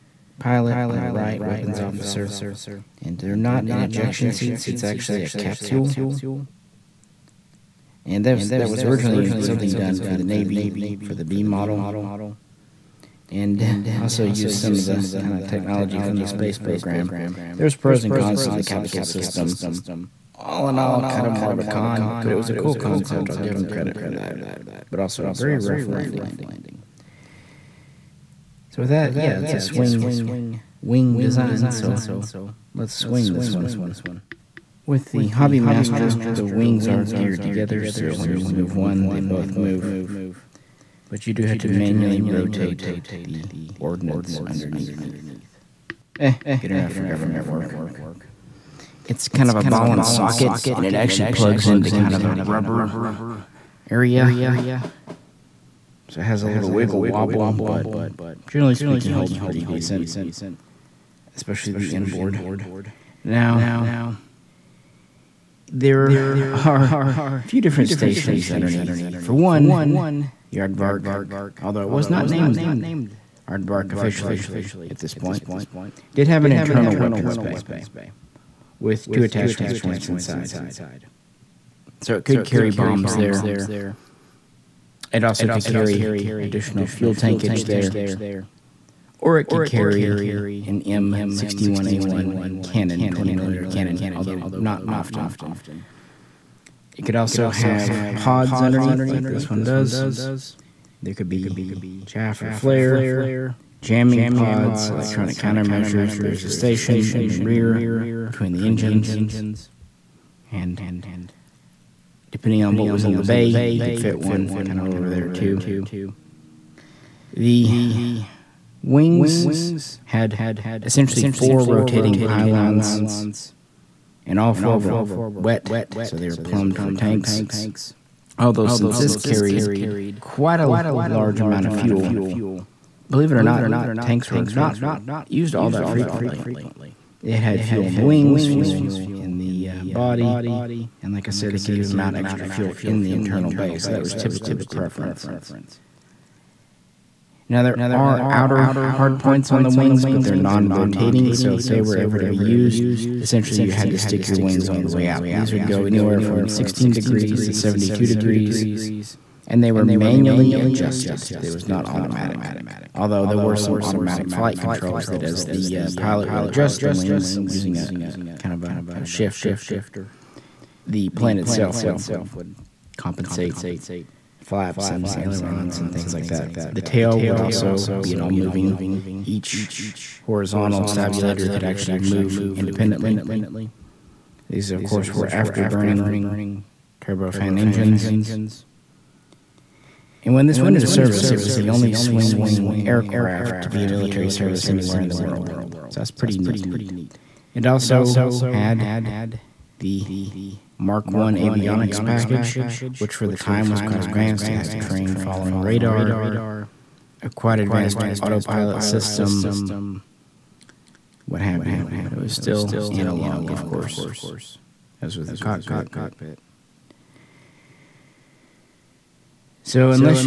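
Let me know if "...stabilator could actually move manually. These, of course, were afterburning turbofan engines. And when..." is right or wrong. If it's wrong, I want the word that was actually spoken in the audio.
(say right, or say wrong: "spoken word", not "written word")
wrong: "independently", not "manually".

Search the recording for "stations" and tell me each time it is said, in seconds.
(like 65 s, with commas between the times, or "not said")
67 s, 106 s.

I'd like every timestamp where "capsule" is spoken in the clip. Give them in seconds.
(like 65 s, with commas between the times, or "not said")
5 s, 18 s.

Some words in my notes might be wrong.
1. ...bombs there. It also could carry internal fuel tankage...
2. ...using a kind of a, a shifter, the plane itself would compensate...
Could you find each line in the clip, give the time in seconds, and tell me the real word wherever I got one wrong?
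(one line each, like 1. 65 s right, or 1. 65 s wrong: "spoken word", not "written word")
1. 82 s wrong: "additional", not "internal"
2. 167 s right.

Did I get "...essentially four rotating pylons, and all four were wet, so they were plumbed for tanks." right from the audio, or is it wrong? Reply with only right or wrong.
right.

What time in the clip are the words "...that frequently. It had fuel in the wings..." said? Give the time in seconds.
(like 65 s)
135 s.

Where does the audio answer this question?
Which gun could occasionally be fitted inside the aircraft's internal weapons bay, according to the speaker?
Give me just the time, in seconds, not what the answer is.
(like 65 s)
90 s.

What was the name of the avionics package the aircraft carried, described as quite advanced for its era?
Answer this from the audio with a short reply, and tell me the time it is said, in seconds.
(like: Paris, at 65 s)
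Mark 1, at 200 s.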